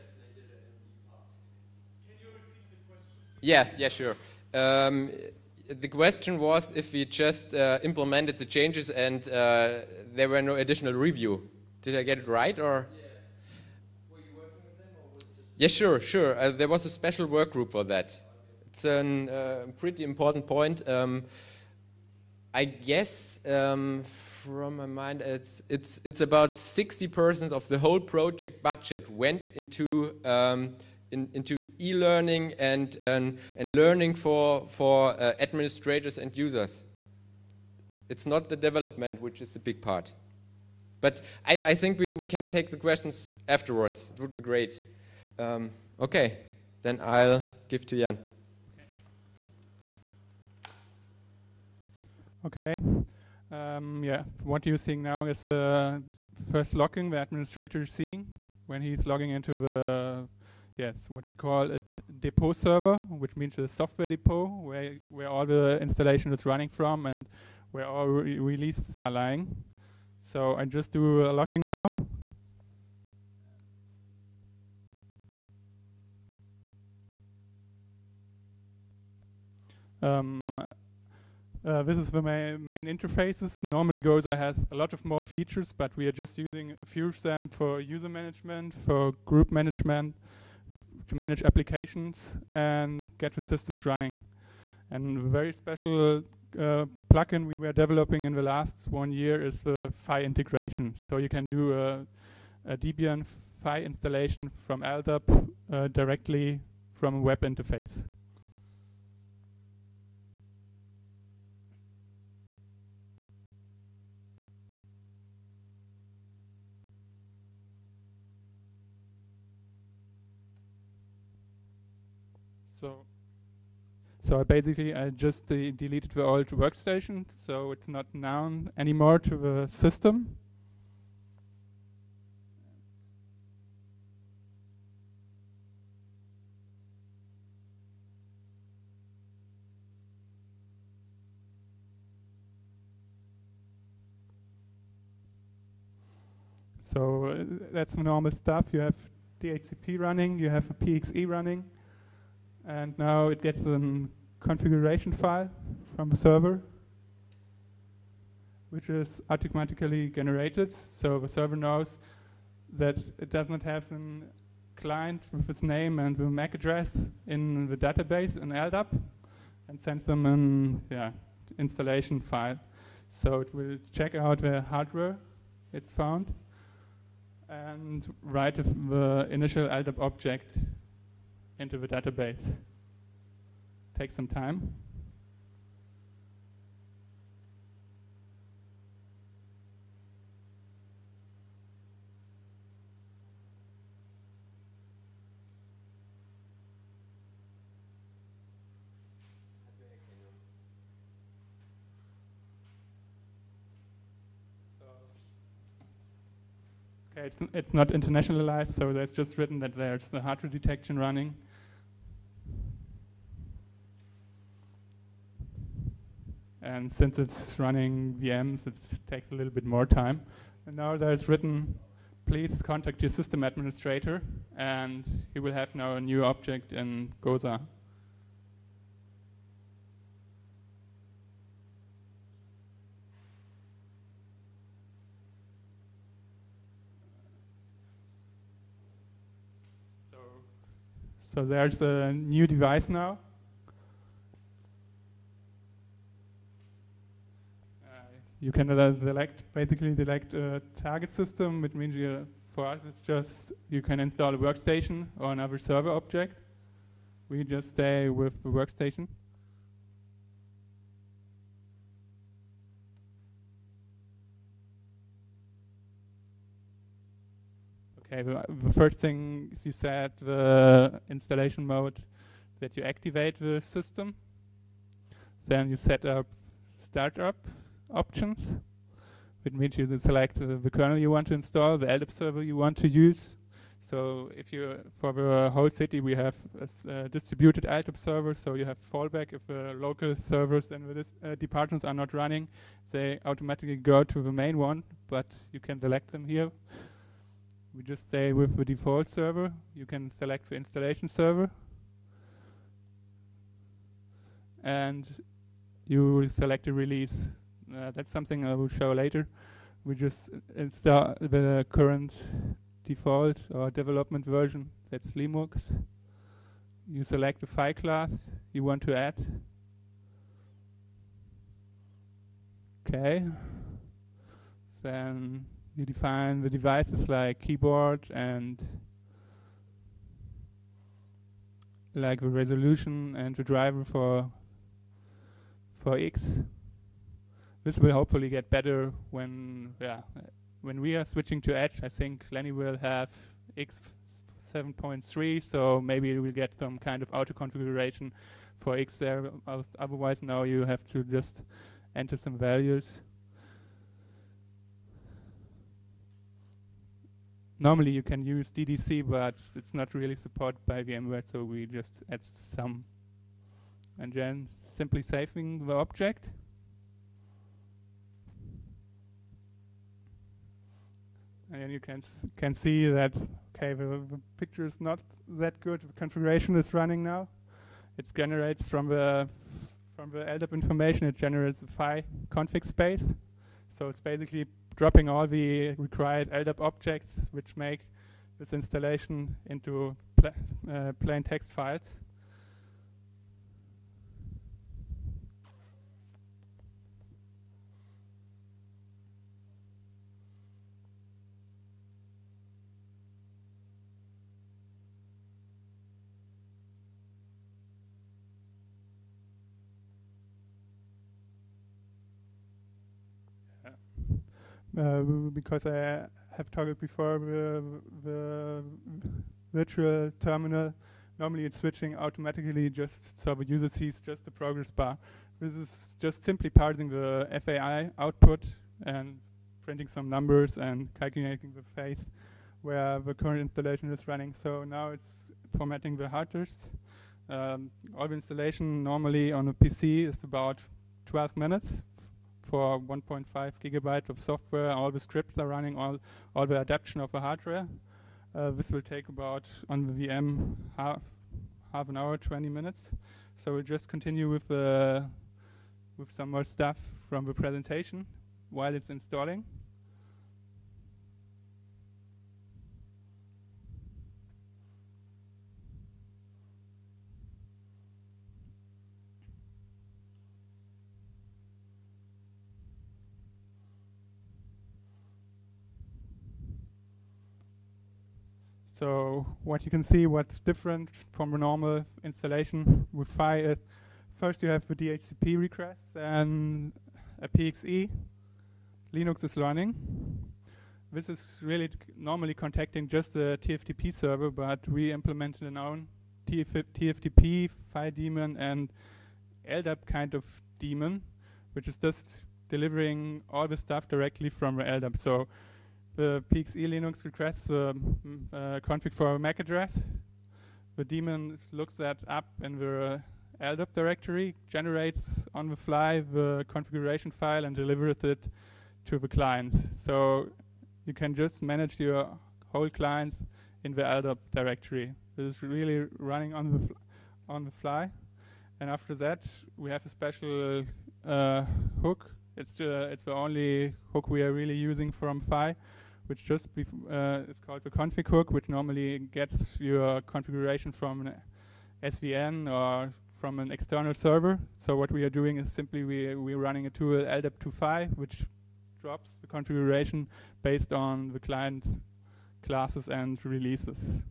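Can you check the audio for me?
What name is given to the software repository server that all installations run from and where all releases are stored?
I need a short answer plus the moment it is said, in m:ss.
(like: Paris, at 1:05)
depot server, at 1:02.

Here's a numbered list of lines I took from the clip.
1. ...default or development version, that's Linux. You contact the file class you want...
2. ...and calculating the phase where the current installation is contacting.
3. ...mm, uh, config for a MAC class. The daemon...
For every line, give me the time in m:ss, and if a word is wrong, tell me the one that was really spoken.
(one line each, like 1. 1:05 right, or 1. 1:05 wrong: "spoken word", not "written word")
1. 5:12 wrong: "select", not "contact"
2. 7:10 wrong: "running", not "contacting"
3. 8:27 wrong: "address", not "class".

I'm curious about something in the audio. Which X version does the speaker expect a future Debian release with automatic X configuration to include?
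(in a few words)
7.3.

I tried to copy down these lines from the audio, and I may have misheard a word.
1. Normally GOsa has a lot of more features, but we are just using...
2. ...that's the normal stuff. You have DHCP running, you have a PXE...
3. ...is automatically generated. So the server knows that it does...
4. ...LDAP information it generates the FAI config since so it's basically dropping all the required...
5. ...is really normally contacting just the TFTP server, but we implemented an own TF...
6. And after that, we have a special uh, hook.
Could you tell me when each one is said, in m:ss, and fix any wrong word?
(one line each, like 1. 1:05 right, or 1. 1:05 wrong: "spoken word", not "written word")
1. 1:23 right
2. 2:27 right
3. 2:38 right
4. 6:20 wrong: "space", not "since"
5. 8:11 right
6. 8:48 right.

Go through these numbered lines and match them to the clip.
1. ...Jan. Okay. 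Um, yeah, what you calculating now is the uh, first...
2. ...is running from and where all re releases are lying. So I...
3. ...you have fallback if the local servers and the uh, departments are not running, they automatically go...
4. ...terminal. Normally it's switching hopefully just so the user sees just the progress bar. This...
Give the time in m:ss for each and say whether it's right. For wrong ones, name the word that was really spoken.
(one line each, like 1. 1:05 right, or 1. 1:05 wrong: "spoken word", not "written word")
1. 0:47 wrong: "seeing", not "calculating"
2. 1:06 right
3. 4:48 right
4. 7:00 wrong: "automatically", not "hopefully".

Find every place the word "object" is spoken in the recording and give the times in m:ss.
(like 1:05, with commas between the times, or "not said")
2:59, 3:46, 4:15, 6:05, 6:26.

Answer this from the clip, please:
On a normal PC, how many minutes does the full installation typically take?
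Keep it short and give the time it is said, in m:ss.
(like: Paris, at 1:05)
12 minutes, at 7:21.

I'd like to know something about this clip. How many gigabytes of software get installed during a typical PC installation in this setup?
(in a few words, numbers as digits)
1.5 gigabytes.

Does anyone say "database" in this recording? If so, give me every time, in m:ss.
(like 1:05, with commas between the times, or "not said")
2:47, 3:01.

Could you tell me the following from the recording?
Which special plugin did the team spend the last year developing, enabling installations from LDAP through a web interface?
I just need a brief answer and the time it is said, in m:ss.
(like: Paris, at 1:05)
FAI integration, at 1:40.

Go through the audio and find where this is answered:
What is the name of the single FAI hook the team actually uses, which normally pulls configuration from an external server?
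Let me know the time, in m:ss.
8:57.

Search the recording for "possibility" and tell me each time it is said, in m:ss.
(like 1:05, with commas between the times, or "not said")
not said.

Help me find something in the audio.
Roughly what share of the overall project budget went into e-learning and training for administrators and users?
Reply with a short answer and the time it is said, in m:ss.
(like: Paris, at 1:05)
60 percent, at 0:26.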